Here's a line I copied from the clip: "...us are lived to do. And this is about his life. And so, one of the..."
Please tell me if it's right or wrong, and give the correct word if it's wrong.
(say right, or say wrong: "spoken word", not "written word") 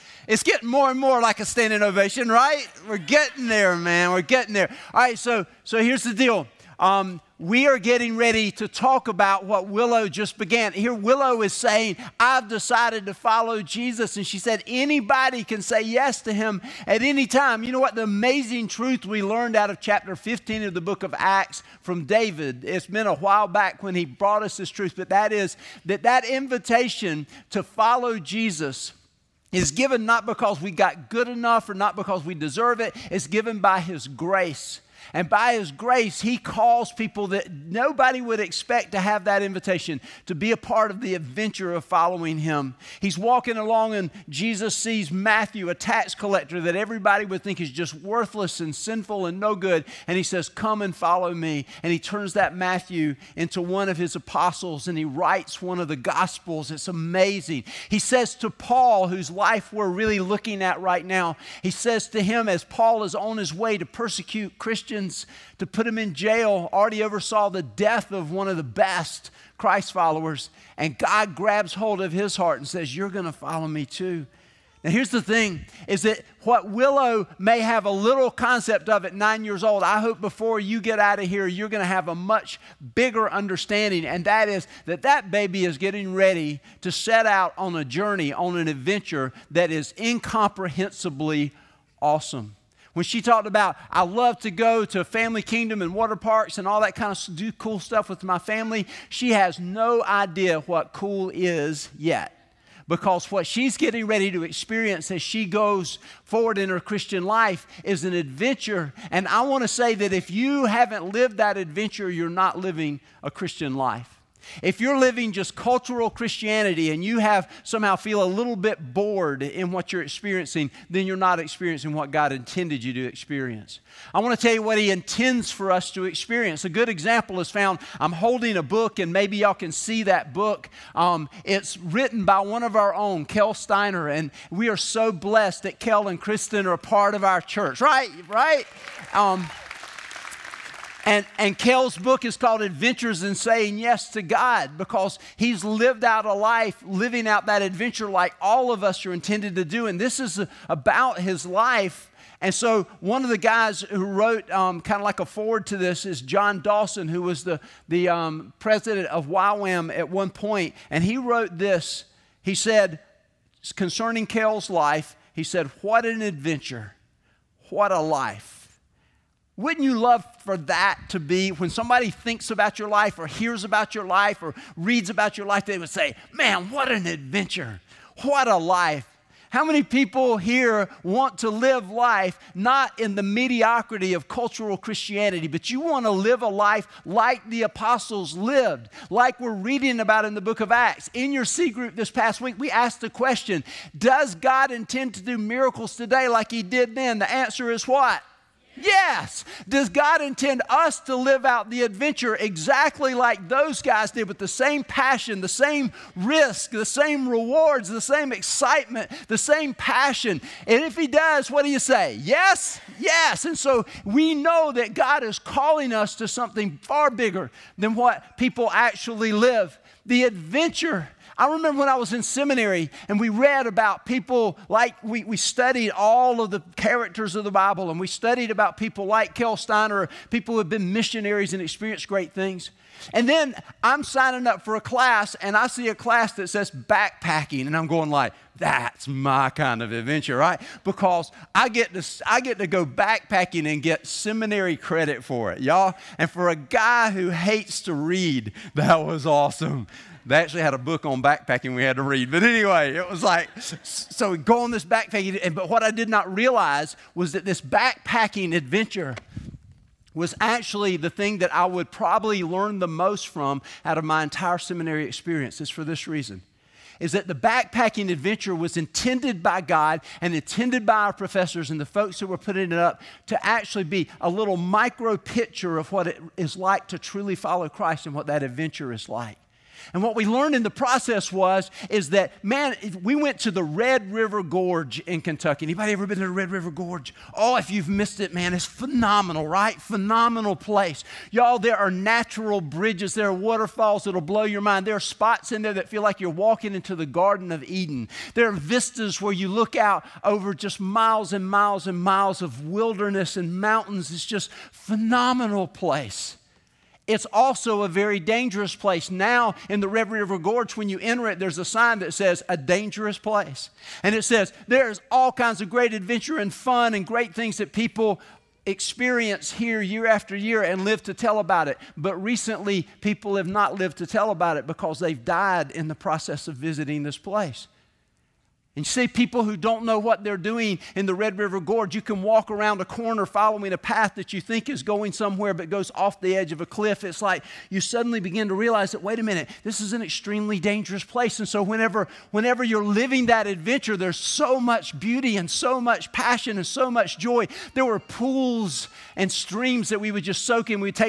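wrong: "intended", not "lived".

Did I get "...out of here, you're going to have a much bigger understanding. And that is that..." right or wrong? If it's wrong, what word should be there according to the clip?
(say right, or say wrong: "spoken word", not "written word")
right.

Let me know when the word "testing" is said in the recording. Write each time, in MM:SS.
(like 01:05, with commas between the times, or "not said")
not said.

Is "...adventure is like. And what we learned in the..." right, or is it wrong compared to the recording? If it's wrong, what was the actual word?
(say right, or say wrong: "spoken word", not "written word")
right.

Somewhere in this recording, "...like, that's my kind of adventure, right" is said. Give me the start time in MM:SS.
03:58.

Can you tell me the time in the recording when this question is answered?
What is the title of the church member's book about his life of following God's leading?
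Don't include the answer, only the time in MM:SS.
02:22.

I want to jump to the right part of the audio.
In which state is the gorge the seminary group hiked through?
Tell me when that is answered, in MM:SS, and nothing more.
04:45.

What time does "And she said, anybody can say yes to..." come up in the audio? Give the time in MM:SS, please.
00:14.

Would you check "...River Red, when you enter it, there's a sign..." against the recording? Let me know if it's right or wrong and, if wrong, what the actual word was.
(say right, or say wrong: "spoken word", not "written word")
wrong: "Gorge", not "Red".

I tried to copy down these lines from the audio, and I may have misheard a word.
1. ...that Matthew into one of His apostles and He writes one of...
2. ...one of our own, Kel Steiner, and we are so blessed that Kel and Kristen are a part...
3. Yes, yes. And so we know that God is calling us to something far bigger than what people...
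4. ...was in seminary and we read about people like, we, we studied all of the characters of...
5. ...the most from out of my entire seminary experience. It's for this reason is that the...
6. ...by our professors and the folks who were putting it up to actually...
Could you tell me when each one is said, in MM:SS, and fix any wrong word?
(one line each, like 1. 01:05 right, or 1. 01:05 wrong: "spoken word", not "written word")
1. 00:52 right
2. 02:12 right
3. 03:32 right
4. 03:41 right
5. 04:22 right
6. 04:30 right.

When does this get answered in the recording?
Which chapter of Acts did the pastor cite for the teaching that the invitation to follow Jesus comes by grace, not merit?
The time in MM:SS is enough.
00:20.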